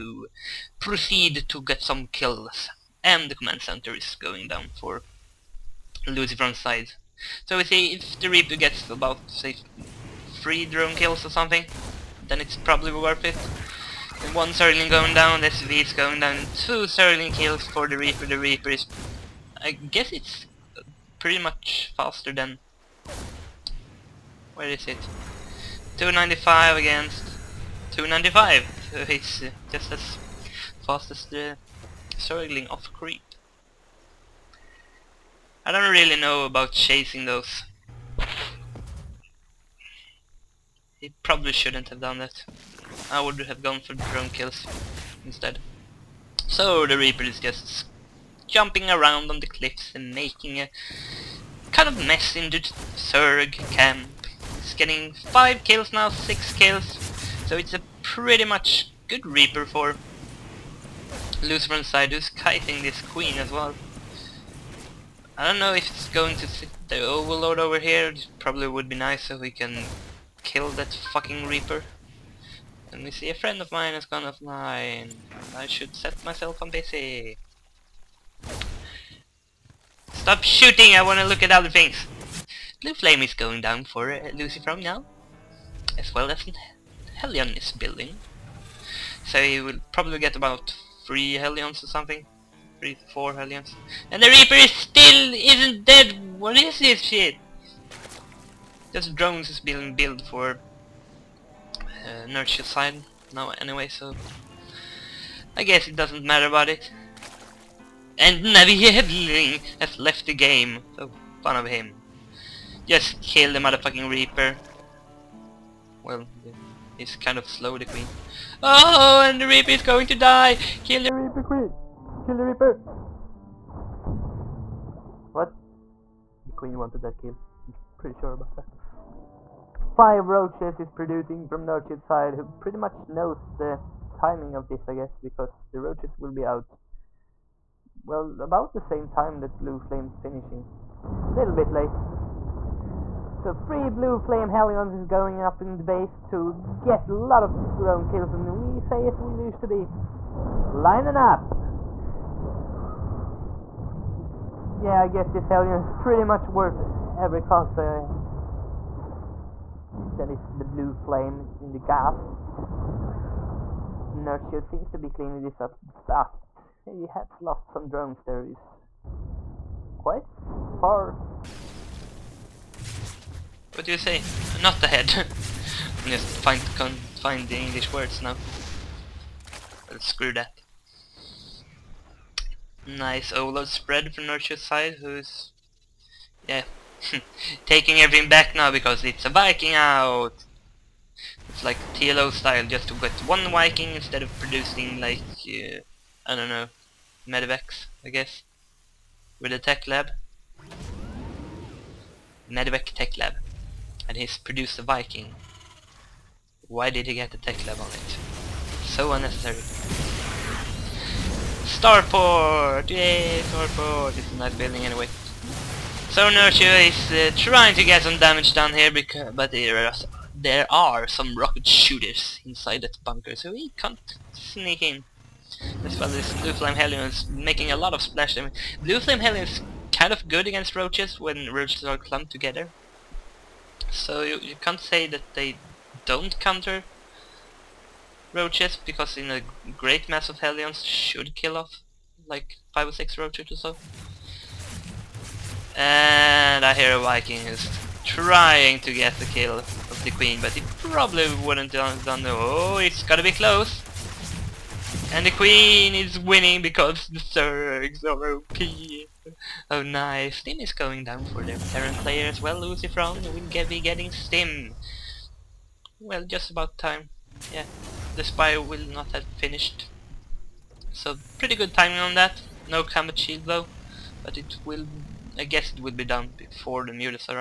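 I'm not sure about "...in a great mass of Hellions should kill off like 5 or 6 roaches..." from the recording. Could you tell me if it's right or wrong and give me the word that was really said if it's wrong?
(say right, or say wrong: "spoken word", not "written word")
right.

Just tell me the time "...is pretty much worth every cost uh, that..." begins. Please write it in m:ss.
2:35.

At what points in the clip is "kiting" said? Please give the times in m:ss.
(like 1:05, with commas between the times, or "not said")
1:02.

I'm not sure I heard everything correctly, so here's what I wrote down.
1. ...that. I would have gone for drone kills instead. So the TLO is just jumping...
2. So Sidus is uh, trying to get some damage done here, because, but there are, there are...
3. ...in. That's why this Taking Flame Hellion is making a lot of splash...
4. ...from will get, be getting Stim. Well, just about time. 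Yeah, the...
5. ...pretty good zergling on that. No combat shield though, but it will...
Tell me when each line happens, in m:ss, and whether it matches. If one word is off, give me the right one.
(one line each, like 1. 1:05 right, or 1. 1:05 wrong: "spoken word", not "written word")
1. 0:42 wrong: "Reaper", not "TLO"
2. 3:36 wrong: "Nerchio", not "Sidus"
3. 3:44 wrong: "Blue", not "Taking"
4. 4:22 right
5. 4:31 wrong: "timing", not "zergling".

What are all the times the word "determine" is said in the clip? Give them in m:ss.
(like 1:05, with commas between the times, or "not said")
not said.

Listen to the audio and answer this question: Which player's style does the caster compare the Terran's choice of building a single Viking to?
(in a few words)
TLO.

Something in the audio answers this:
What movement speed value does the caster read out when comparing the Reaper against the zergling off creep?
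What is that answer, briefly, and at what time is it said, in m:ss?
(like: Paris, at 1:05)
295, at 0:25.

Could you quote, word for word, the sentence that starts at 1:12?
And we see a friend of mine has gone offline.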